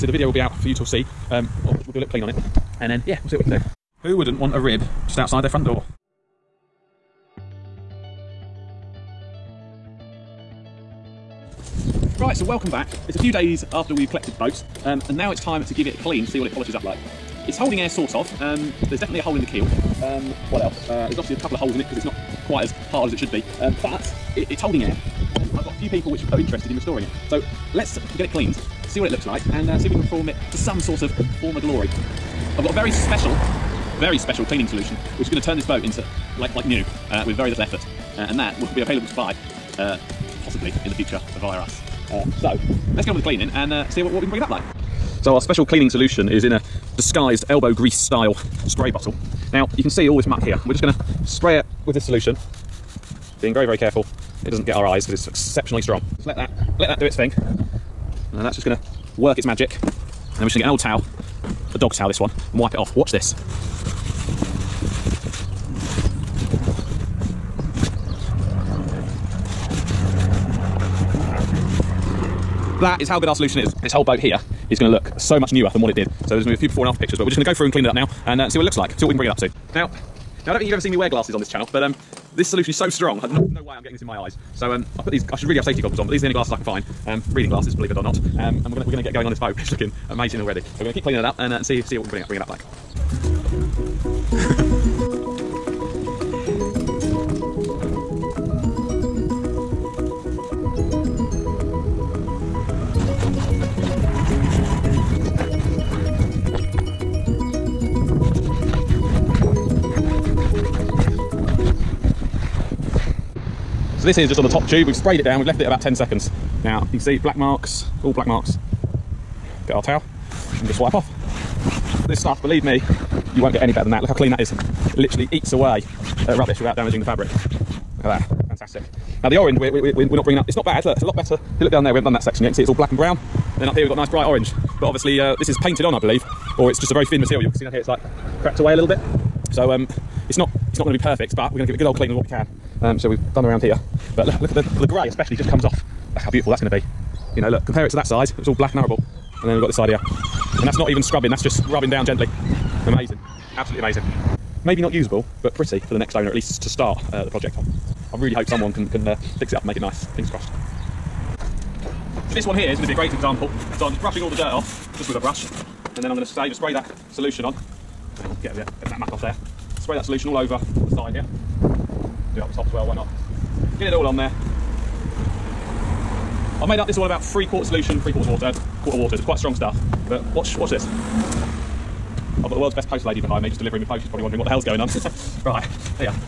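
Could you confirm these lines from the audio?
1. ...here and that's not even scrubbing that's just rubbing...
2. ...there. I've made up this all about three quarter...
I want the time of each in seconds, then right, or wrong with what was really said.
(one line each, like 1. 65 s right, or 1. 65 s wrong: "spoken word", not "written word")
1. 149 s right
2. 174 s right.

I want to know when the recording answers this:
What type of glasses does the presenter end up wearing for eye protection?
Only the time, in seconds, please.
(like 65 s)
87 s.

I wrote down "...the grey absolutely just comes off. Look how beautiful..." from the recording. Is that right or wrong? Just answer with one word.
wrong.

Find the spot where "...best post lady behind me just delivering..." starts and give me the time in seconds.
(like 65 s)
182 s.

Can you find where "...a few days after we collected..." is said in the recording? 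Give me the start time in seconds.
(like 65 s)
13 s.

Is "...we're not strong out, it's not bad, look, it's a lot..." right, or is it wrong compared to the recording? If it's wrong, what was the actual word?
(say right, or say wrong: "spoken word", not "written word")
wrong: "bringing", not "strong".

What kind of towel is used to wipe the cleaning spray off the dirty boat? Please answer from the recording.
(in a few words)
Dog towel.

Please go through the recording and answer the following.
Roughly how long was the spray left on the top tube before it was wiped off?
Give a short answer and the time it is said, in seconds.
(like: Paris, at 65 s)
10 seconds, at 115 s.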